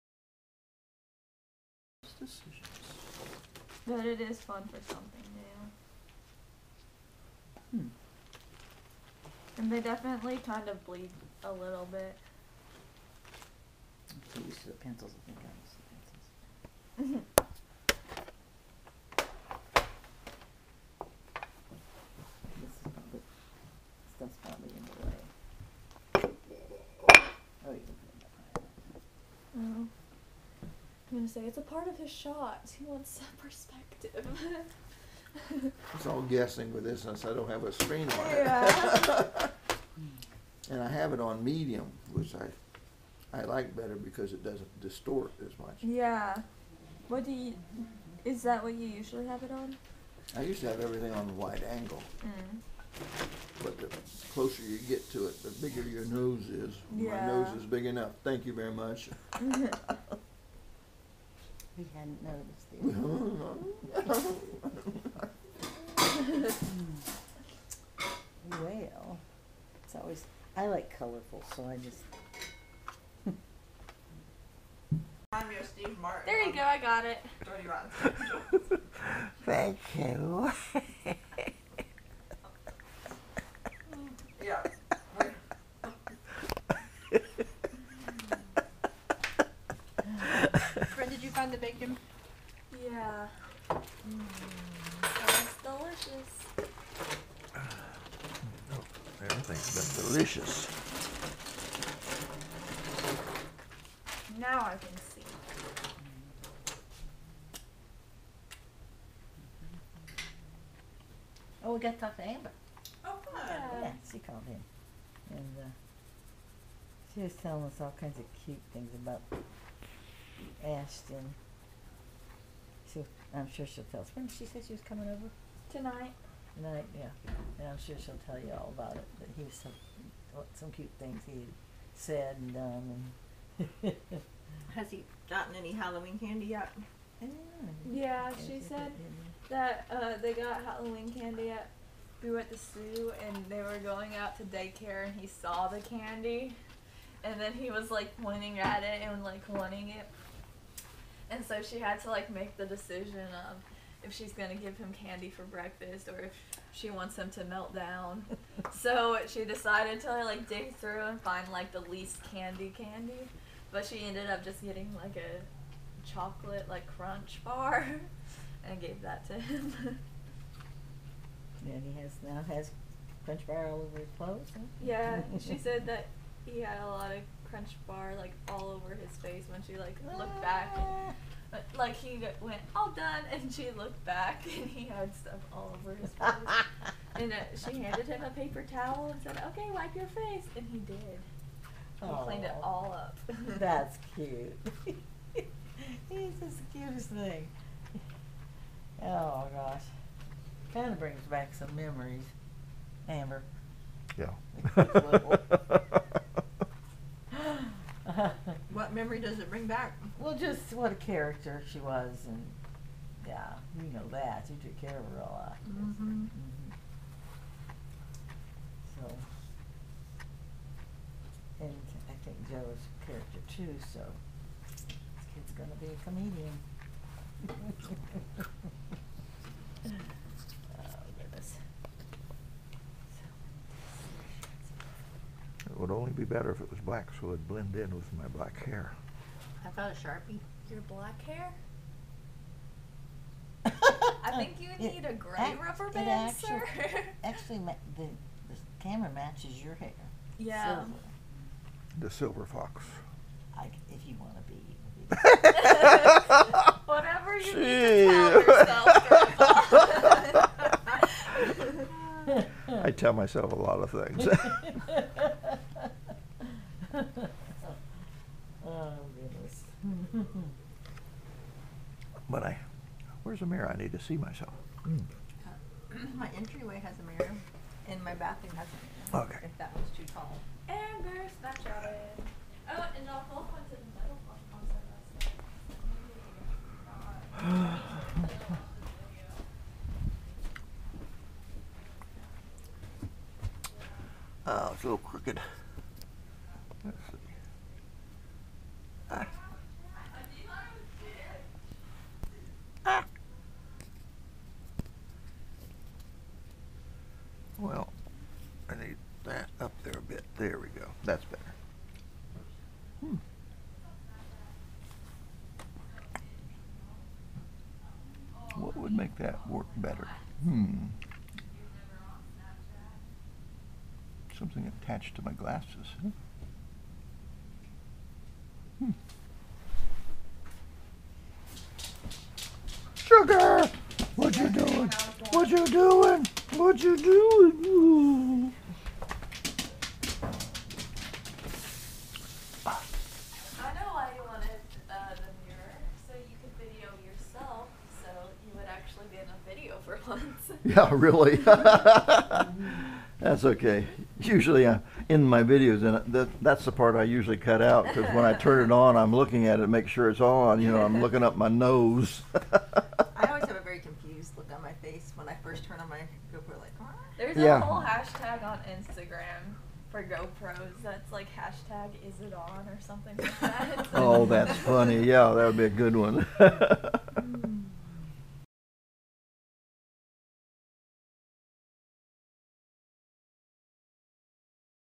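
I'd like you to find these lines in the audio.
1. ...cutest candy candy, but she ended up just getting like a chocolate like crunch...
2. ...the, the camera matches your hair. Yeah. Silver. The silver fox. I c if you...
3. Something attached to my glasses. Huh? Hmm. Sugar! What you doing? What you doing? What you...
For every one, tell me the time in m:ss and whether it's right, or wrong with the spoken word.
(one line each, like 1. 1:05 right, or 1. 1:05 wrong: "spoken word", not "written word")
1. 2:41 wrong: "least", not "cutest"
2. 4:07 right
3. 5:24 right.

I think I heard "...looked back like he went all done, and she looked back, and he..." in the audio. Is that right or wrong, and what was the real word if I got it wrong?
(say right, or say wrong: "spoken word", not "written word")
right.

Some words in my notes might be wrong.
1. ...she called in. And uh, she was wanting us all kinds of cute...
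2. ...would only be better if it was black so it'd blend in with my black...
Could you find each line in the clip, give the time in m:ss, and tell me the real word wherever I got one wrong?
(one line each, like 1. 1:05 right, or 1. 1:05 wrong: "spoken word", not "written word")
1. 1:54 wrong: "telling", not "wanting"
2. 3:55 right.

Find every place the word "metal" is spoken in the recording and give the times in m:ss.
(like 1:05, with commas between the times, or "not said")
4:43.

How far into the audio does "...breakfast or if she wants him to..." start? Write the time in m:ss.
2:35.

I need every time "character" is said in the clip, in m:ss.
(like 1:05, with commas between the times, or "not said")
3:30, 3:43.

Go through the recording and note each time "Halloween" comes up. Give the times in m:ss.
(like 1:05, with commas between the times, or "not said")
2:15, 2:20.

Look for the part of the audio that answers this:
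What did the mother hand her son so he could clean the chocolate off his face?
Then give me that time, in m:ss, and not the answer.
3:08.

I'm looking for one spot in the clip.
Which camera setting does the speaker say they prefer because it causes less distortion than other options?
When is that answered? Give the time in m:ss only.
0:41.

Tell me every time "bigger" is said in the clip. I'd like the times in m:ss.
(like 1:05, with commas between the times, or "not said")
0:55.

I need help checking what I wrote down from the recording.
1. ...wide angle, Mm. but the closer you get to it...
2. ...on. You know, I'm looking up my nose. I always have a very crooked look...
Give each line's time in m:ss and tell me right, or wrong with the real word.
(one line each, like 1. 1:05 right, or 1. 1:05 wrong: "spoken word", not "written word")
1. 0:51 right
2. 6:00 wrong: "confused", not "crooked".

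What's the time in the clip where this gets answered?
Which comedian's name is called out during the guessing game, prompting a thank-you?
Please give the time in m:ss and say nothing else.
1:15.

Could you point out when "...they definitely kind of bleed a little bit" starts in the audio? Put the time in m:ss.
0:09.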